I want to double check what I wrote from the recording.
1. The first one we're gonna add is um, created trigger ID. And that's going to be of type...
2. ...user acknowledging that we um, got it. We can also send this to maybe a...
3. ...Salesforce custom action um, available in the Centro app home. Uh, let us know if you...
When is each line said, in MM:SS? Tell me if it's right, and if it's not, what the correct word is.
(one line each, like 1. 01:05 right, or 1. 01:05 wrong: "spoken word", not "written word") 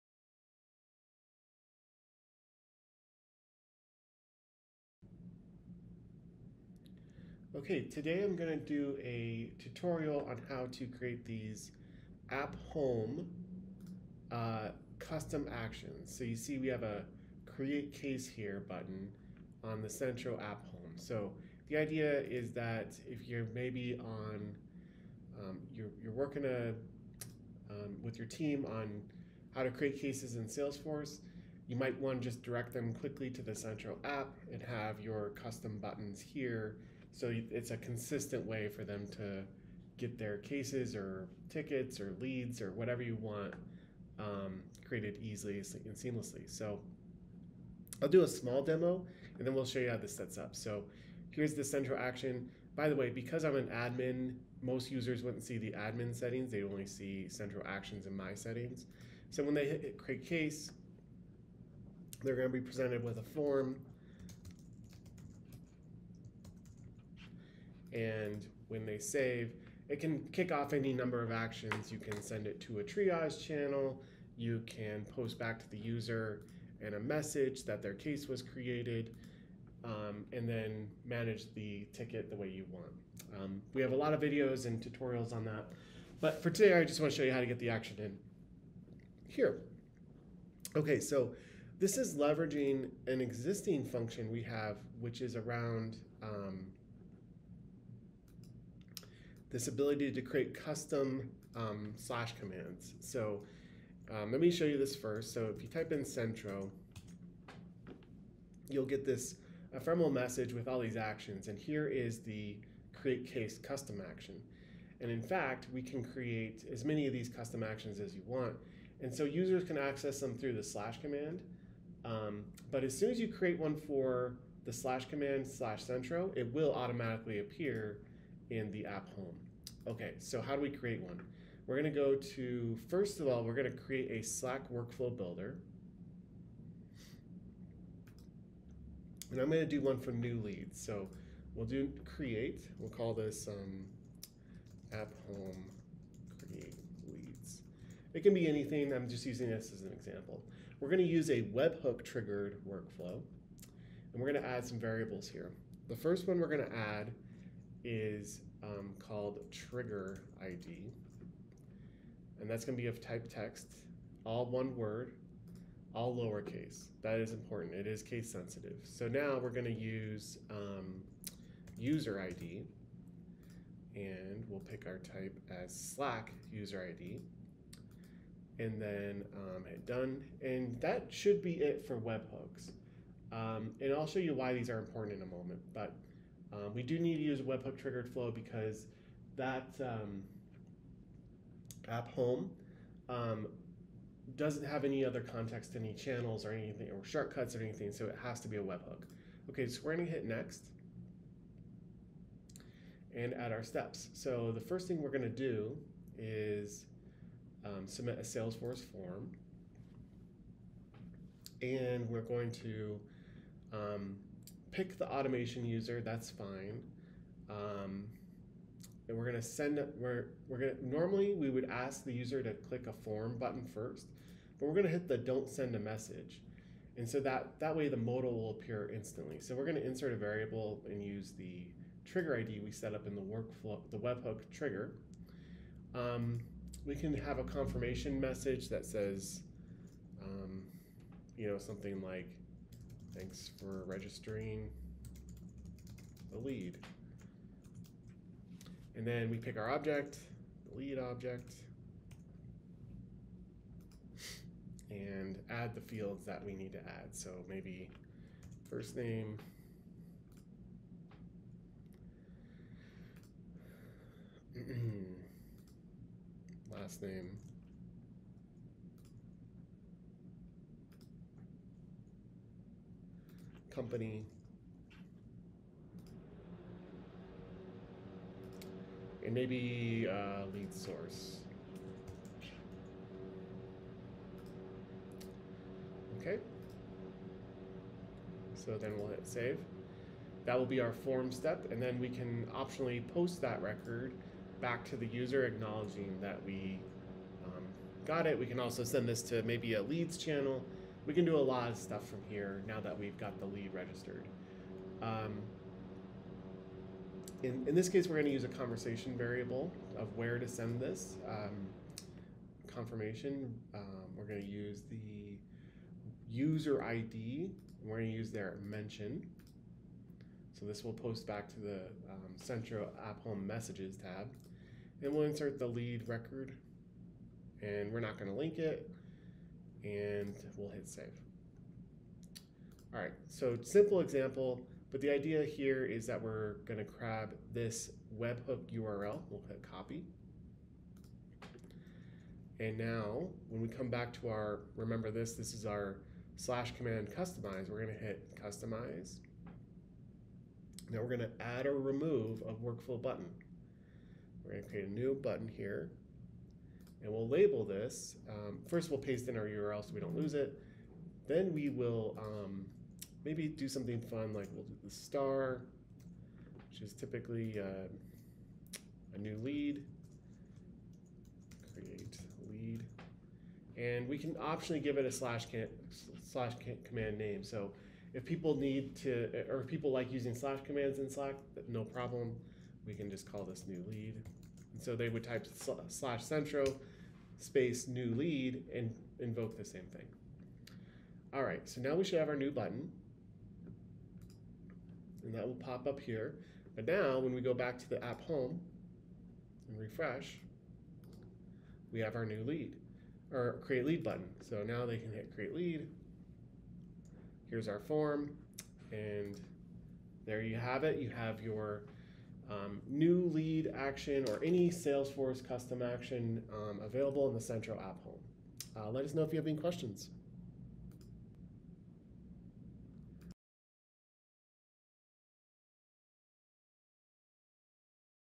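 1. 02:35 wrong: "called", not "created"
2. 04:55 right
3. 06:54 right.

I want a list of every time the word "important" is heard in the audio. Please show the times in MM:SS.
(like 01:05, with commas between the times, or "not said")
02:47, 03:04.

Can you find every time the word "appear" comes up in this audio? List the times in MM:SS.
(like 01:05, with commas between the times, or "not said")
02:07, 03:48.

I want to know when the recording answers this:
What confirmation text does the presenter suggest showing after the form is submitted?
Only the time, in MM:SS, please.
04:03.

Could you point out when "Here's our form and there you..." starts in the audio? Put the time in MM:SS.
06:47.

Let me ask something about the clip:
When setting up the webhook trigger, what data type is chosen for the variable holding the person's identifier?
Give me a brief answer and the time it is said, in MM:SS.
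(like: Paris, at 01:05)
Slack user ID, at 02:55.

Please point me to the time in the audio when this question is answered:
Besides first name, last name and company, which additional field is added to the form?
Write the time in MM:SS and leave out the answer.
04:40.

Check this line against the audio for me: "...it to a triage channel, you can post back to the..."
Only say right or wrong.
right.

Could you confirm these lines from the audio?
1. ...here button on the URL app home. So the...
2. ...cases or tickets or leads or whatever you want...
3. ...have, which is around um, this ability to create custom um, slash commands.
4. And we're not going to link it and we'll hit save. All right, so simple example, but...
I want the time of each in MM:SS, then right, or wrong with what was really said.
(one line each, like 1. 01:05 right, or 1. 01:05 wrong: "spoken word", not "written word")
1. 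00:18 wrong: "Centro", not "URL"
2. 00:40 right
3. 01:34 right
4. 05:27 right.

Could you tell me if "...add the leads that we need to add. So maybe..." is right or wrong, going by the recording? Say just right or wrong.
wrong.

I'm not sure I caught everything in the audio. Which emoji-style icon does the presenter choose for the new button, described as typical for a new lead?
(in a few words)
star.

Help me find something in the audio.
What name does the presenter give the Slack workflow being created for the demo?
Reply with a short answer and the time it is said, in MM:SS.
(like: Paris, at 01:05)
app home create leads, at 02:24.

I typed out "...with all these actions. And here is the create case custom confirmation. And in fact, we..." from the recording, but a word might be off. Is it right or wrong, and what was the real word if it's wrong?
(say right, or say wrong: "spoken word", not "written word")
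wrong: "action", not "confirmation".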